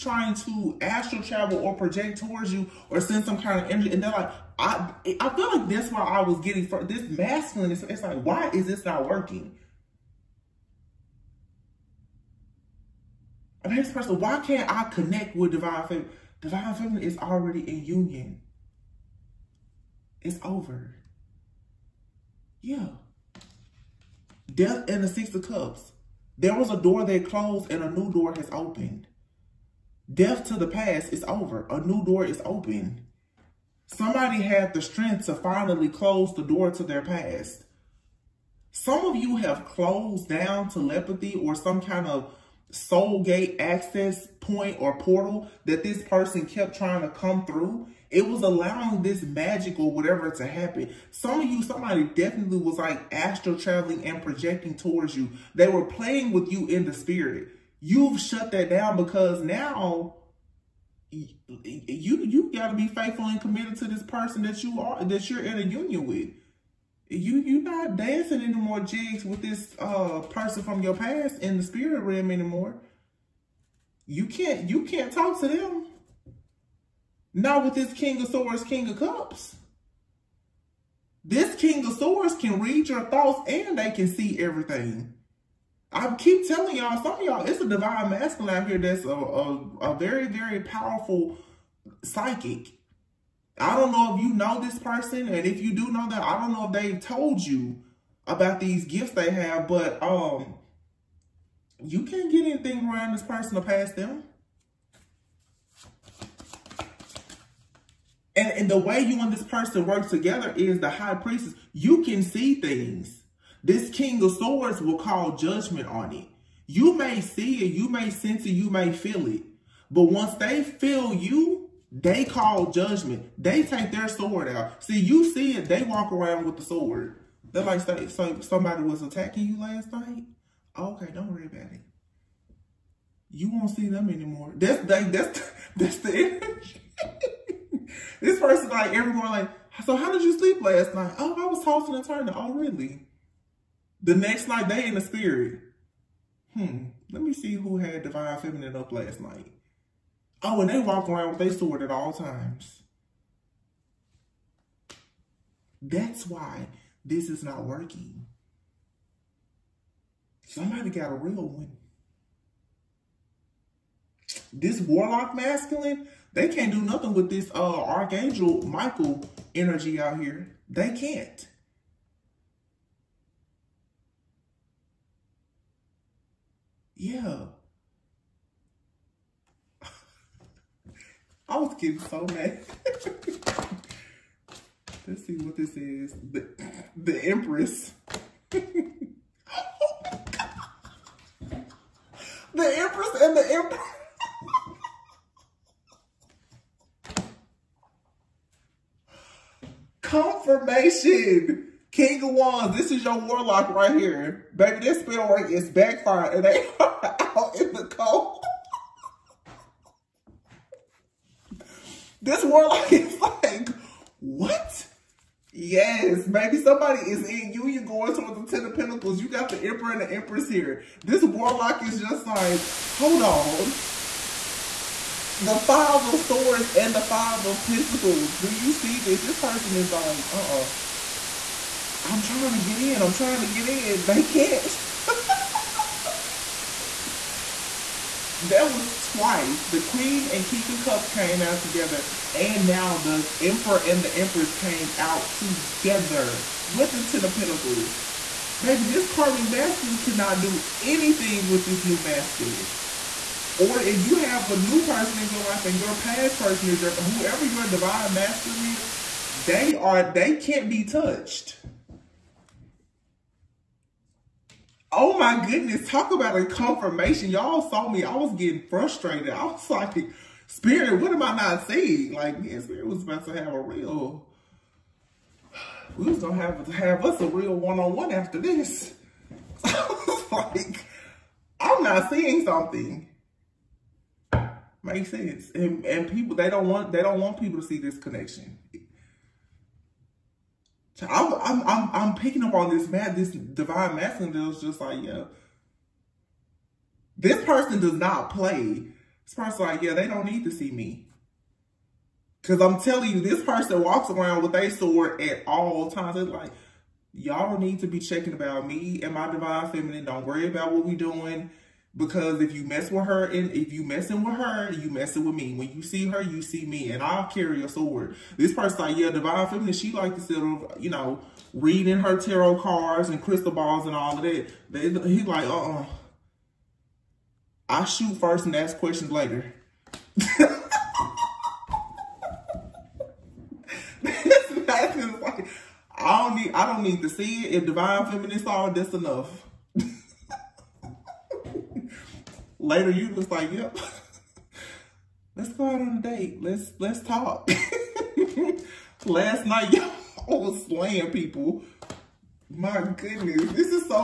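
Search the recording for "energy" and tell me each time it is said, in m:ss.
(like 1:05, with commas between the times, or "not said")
0:03, 2:16, 2:49.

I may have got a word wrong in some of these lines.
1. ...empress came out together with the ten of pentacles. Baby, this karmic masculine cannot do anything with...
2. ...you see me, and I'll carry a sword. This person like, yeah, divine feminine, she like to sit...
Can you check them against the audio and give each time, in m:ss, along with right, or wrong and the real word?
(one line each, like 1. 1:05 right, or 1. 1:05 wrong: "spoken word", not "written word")
1. 4:04 right
2. 5:16 right.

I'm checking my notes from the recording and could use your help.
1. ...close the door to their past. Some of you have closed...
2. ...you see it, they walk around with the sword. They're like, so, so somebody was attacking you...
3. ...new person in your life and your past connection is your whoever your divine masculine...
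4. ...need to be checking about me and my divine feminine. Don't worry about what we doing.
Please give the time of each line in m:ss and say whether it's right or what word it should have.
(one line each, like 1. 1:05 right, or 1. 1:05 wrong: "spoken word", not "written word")
1. 0:35 right
2. 2:04 right
3. 4:14 wrong: "person", not "connection"
4. 5:07 right.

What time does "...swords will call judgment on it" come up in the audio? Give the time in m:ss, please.
1:54.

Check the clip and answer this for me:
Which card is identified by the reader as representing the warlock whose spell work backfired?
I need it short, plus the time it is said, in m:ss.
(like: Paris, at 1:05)
King of Wands, at 3:21.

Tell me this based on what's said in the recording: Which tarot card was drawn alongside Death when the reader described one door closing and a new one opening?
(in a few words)
Six of Cups.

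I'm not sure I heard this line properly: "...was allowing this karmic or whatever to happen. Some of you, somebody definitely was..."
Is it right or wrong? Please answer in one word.
wrong.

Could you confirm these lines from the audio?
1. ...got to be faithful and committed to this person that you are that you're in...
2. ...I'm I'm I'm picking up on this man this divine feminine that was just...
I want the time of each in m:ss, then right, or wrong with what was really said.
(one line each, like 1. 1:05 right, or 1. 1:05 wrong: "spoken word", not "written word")
1. 1:02 right
2. 4:51 wrong: "masculine", not "feminine".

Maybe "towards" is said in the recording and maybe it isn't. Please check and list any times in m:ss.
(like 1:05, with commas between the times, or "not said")
0:02, 0:54, 3:38.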